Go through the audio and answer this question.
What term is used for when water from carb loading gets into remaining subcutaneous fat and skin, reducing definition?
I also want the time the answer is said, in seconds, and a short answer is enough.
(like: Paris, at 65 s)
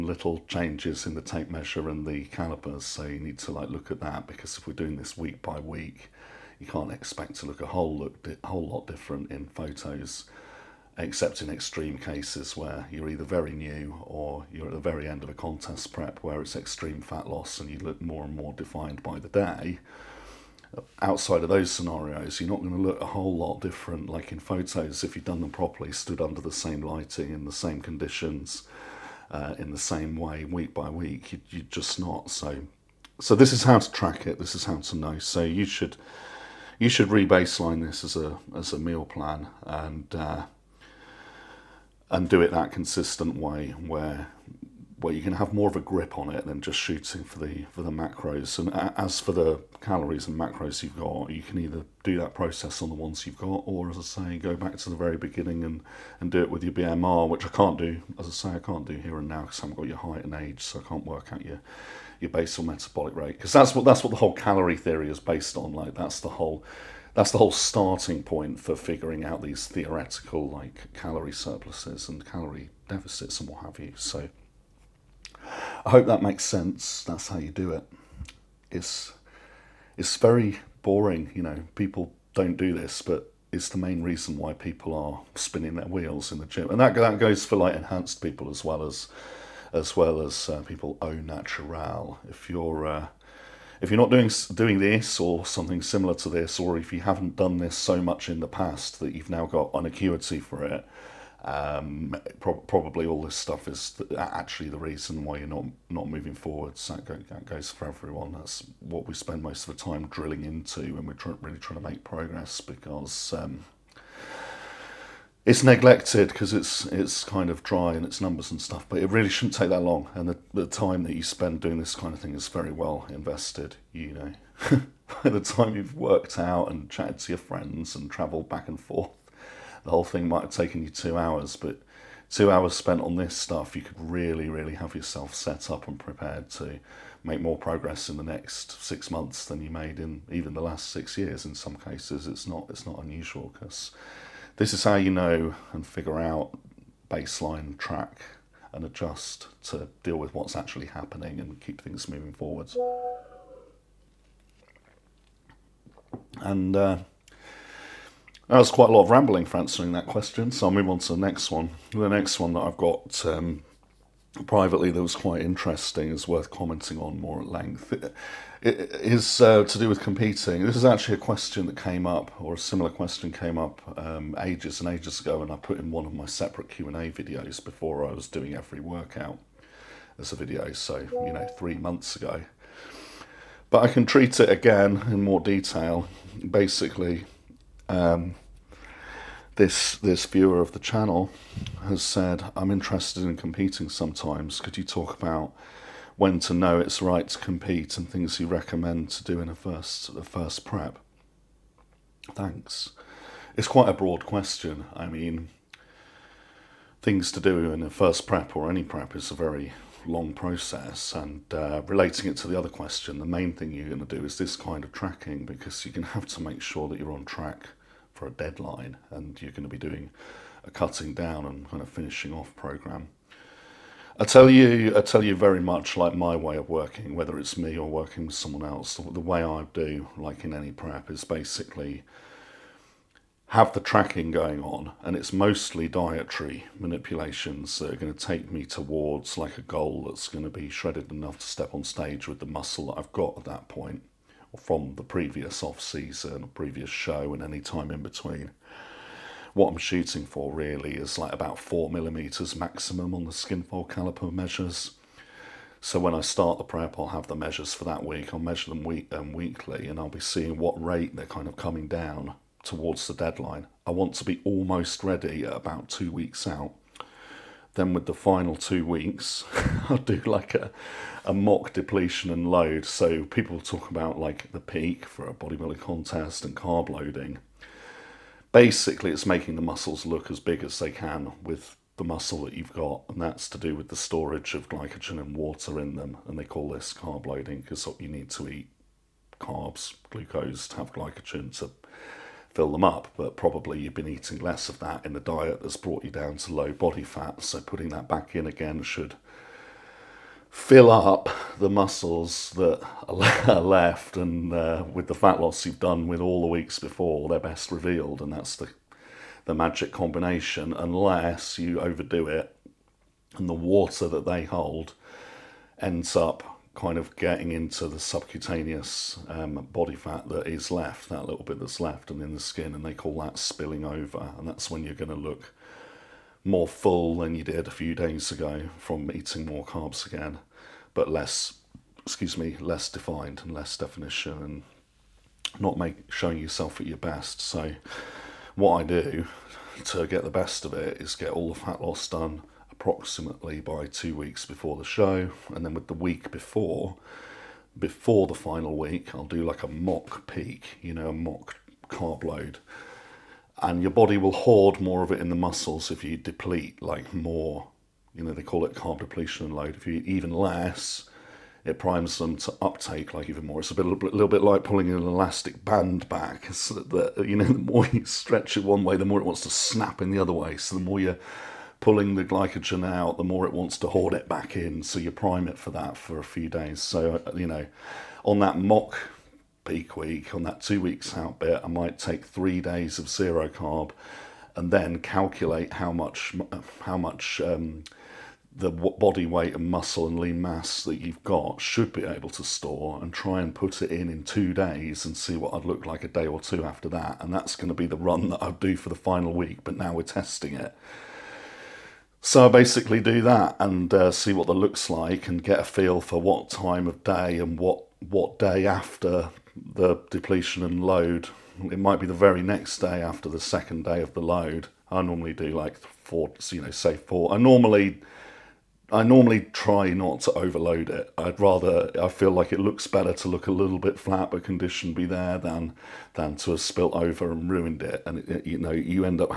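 spilling over, at 323 s.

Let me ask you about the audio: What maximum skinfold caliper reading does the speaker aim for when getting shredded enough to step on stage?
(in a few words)
4 millimeters.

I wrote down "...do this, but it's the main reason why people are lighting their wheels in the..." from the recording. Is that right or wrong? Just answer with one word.
wrong.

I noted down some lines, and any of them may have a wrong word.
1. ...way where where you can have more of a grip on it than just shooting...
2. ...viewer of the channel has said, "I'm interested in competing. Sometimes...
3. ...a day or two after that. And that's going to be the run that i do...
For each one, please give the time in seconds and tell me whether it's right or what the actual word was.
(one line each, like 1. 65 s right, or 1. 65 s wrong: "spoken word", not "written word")
1. 43 s right
2. 190 s right
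3. 396 s right.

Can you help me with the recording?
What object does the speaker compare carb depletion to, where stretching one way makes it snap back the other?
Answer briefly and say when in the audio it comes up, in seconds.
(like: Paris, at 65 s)
elastic band, at 365 s.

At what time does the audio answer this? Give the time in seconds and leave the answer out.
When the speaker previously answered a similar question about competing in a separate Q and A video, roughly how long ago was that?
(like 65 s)
181 s.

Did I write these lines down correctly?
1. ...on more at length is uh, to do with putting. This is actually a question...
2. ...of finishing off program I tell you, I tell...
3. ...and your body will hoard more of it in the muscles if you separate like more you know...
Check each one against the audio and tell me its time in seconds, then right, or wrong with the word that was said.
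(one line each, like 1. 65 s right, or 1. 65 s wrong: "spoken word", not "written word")
1. 166 s wrong: "competing", not "putting"
2. 221 s right
3. 353 s wrong: "deplete", not "separate".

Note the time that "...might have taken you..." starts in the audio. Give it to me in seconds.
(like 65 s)
130 s.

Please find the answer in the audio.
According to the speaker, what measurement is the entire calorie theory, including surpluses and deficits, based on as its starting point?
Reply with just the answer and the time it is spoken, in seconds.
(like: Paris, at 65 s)
basal metabolic rate, at 62 s.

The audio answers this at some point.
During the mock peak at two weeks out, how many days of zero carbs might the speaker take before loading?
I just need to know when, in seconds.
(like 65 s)
382 s.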